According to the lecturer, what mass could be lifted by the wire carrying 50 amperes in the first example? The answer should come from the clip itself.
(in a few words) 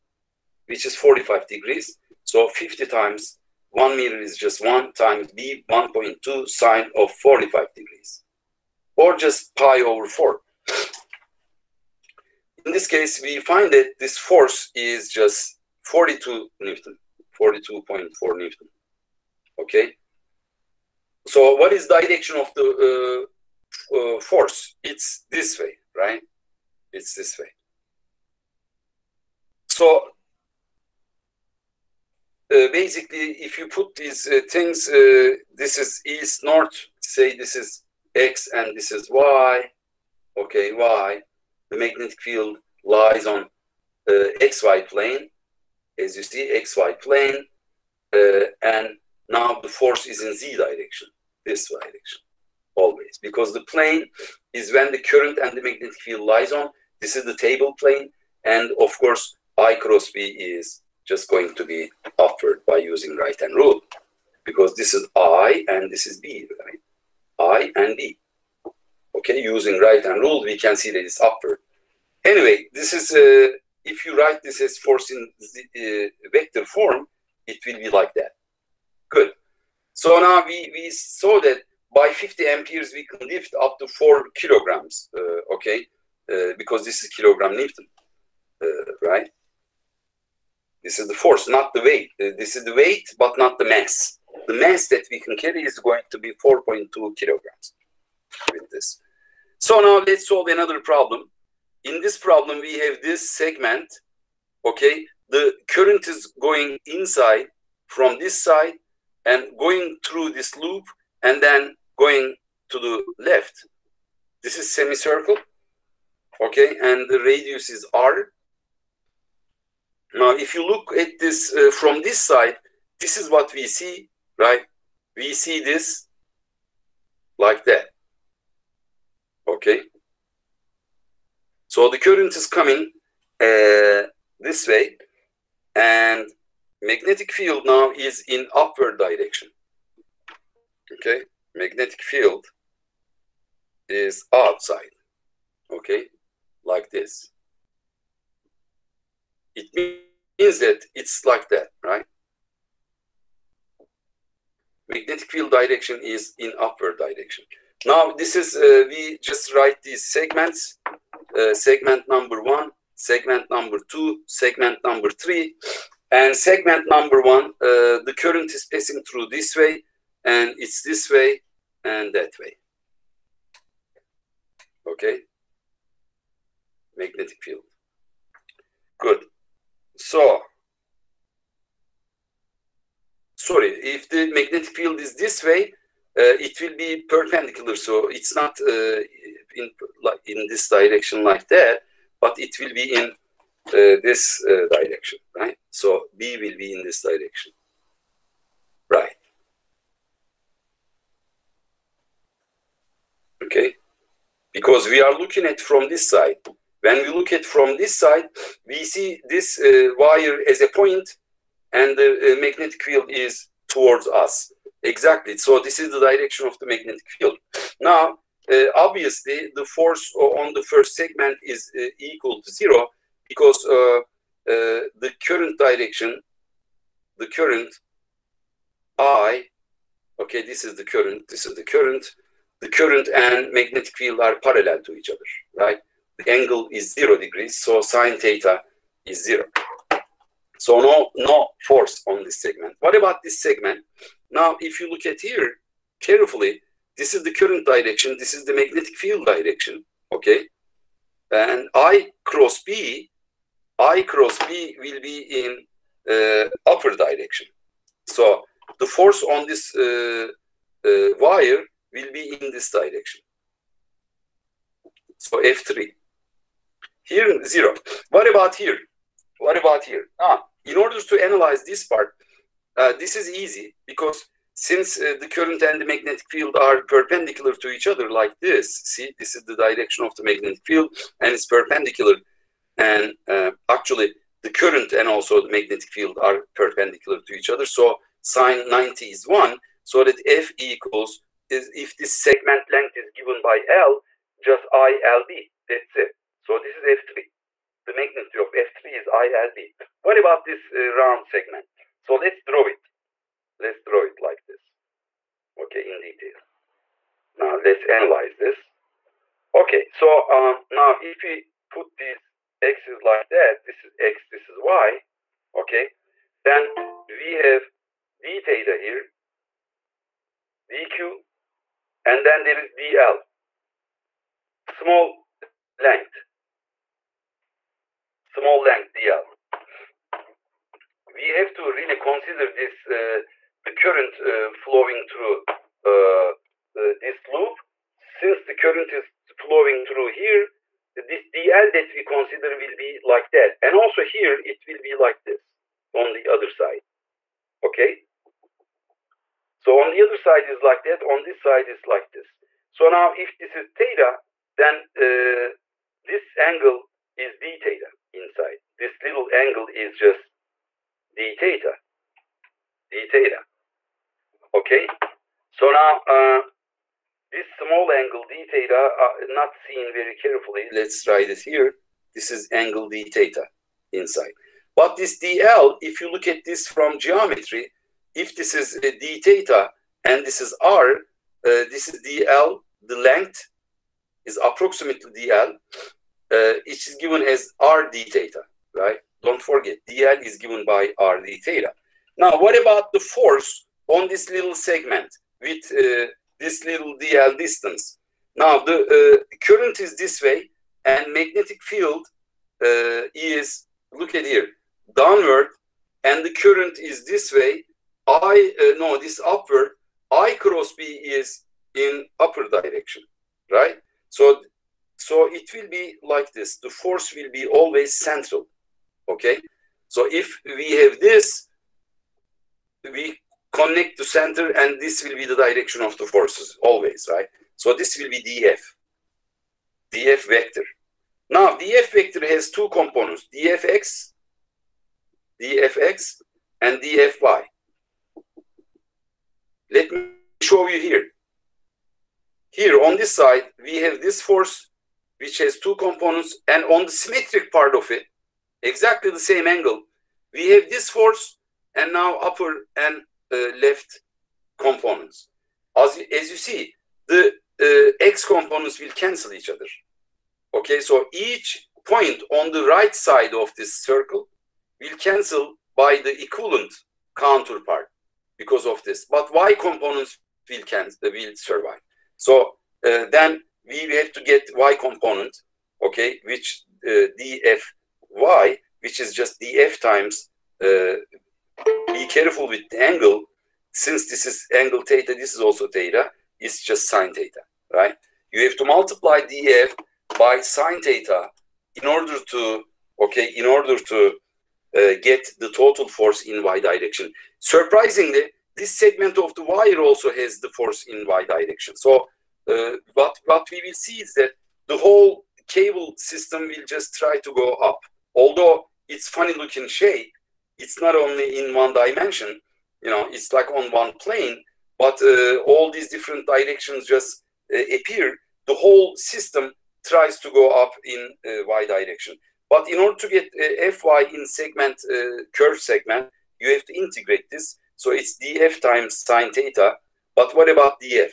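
4.2 kilograms.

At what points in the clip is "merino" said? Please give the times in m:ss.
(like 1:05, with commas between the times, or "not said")
not said.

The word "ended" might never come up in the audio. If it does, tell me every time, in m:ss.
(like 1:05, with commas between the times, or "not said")
not said.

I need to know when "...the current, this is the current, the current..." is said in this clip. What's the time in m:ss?
3:50.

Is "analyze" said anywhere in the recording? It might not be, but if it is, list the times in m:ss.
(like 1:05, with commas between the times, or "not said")
4:31, 5:07.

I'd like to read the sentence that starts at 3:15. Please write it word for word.
So B will be in this direction, right?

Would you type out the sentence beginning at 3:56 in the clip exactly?
The angle is zero degrees, so sine theta is zero.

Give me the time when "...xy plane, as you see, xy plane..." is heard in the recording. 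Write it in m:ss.
0:44.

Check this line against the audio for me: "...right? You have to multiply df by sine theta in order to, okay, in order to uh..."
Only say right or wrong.
right.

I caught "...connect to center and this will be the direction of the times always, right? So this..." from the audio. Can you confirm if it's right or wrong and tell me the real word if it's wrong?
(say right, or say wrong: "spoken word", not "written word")
wrong: "forces", not "times".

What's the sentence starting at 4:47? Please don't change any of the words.
So sine 90 is 1, so that F equals, is if this segment length is given by L, just ILB, that's it.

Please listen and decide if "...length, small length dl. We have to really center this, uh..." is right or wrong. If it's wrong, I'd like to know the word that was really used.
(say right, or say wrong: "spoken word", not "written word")
wrong: "consider", not "center".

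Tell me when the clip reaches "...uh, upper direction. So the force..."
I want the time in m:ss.
4:16.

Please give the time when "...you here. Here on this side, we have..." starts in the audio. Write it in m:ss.
7:20.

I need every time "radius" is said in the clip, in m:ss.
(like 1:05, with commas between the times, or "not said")
1:57.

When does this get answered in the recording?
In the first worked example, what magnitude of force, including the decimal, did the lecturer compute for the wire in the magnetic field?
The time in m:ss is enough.
0:17.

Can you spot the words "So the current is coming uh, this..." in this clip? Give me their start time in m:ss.
2:11.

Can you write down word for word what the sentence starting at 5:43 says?
And also here, it will be like this on the other side.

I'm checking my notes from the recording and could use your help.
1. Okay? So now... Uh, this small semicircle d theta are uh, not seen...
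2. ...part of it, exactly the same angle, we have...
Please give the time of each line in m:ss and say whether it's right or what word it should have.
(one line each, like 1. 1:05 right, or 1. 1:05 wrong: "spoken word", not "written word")
1. 6:04 wrong: "angle", not "semicircle"
2. 7:27 right.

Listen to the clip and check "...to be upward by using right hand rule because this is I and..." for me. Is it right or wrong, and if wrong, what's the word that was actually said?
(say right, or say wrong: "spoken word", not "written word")
right.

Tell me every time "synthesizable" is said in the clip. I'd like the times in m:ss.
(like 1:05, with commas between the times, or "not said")
not said.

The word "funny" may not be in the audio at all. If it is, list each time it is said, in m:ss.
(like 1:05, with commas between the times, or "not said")
8:29.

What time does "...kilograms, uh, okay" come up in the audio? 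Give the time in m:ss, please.
1:24.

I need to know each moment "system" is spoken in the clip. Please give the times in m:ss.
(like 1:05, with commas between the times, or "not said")
8:25, 8:38.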